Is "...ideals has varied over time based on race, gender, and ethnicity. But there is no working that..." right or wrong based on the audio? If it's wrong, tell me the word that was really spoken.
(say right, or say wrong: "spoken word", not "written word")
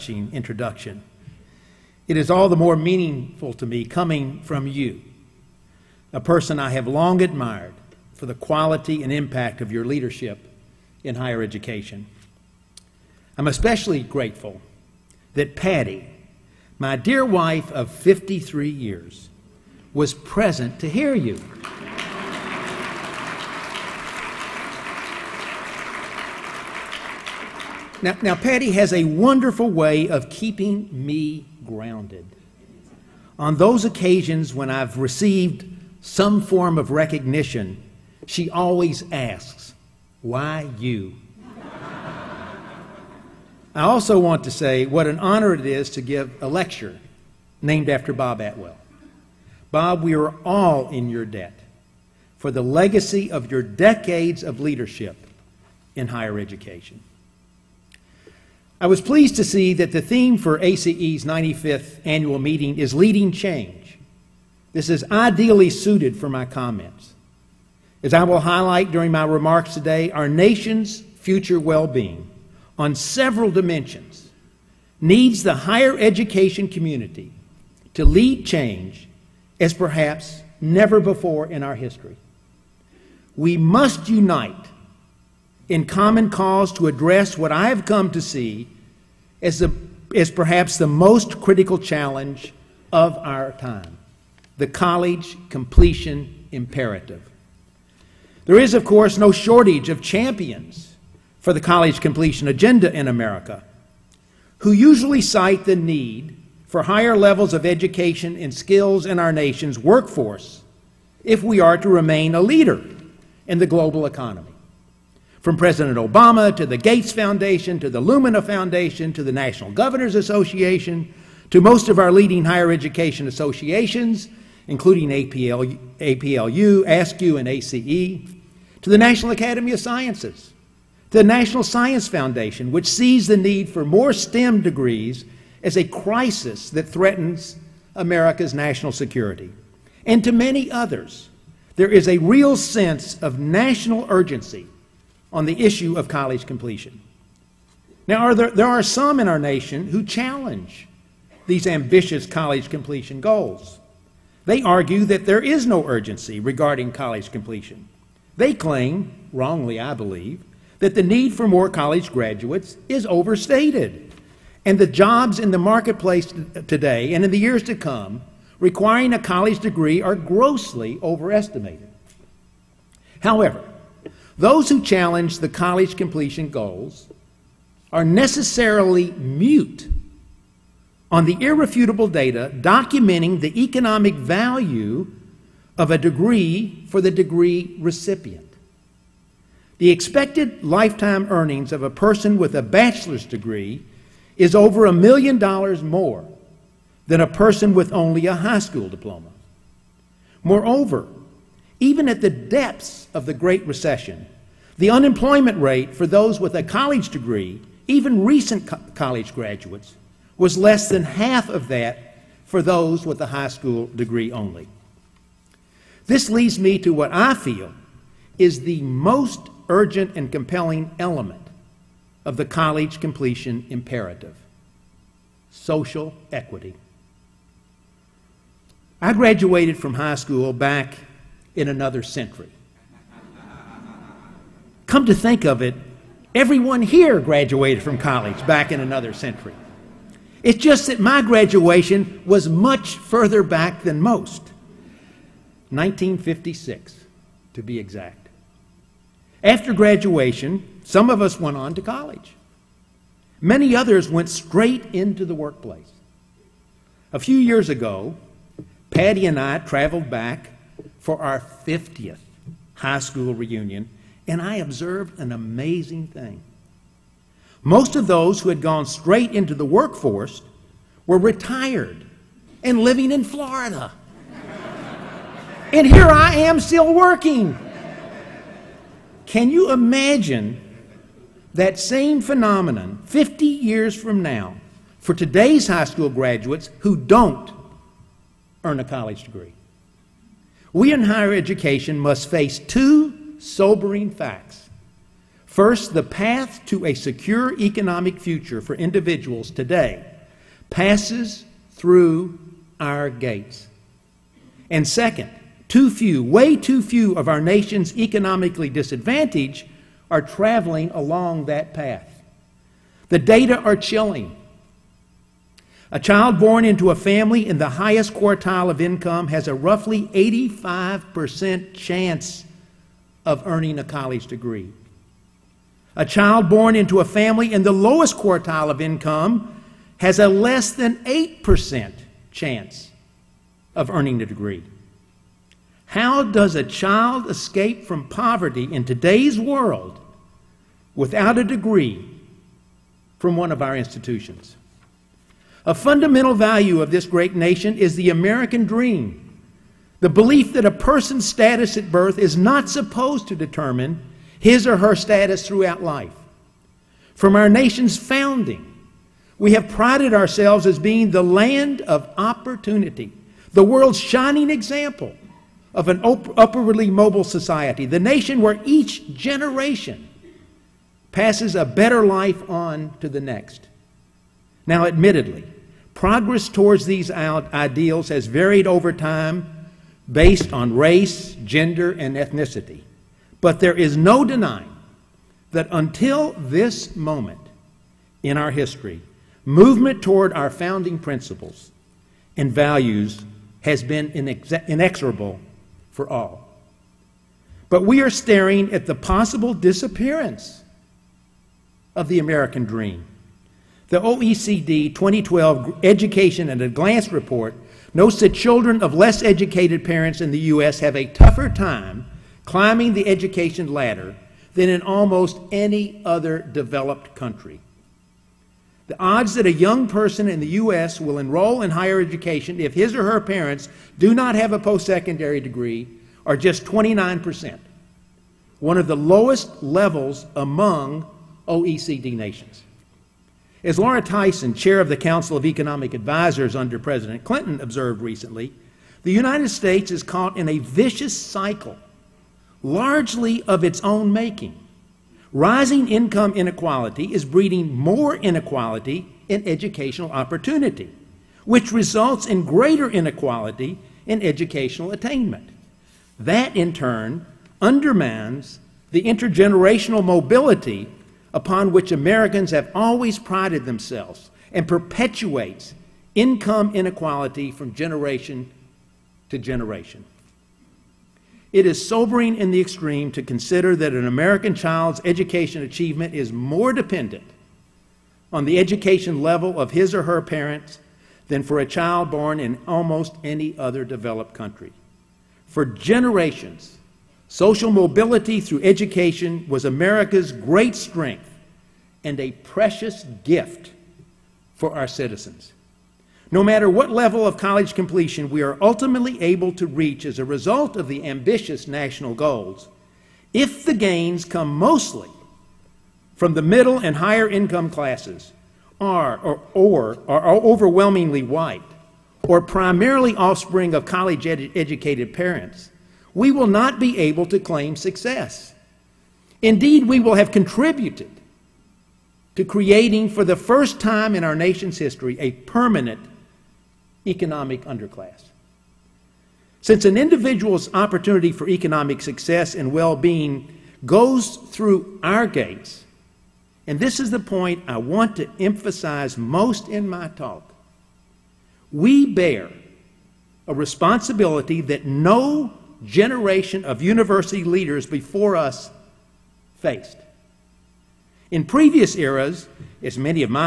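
wrong: "denying", not "working".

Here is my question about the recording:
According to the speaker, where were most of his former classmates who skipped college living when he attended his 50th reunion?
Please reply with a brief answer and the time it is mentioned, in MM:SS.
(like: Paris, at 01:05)
Florida, at 04:33.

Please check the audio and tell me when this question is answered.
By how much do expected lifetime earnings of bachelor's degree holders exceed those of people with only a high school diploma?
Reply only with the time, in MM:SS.
03:14.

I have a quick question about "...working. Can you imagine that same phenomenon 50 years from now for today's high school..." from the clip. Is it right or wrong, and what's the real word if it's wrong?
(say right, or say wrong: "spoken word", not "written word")
right.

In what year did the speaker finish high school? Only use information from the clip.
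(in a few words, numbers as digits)
1956.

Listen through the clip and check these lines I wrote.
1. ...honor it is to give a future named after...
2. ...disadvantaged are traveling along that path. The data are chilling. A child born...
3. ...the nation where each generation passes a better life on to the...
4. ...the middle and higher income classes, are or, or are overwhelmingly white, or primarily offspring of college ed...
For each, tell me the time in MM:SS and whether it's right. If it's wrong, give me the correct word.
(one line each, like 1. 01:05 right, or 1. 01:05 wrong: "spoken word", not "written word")
1. 00:45 wrong: "lecture", not "future"
2. 05:08 right
3. 06:07 right
4. 08:26 right.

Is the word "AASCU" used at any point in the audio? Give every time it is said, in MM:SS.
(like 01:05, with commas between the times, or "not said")
02:06.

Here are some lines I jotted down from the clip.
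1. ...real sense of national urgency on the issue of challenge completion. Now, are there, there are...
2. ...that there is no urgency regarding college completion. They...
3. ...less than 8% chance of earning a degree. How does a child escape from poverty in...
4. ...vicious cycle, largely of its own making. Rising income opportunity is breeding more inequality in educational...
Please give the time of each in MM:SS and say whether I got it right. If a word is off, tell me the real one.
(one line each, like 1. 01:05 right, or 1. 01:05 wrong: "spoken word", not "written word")
1. 02:22 wrong: "college", not "challenge"
2. 02:35 right
3. 05:30 right
4. 07:20 wrong: "inequality", not "opportunity".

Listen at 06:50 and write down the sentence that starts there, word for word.
have a tougher time climbing the education ladder than in almost any other developed country.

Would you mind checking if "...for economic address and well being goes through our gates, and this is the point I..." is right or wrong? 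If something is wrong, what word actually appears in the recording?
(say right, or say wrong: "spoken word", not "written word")
wrong: "success", not "address".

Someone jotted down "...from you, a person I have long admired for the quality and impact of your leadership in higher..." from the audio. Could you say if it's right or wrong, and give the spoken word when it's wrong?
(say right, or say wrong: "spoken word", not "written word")
right.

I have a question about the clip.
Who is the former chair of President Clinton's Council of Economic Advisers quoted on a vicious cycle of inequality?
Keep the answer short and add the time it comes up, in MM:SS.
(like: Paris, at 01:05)
Laura Tyson, at 07:13.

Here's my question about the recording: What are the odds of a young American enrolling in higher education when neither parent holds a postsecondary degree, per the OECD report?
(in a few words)
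29%.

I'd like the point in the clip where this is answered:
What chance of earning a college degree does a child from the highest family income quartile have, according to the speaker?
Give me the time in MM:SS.
05:20.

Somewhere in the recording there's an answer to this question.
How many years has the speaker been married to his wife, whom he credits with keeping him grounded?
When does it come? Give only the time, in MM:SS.
00:17.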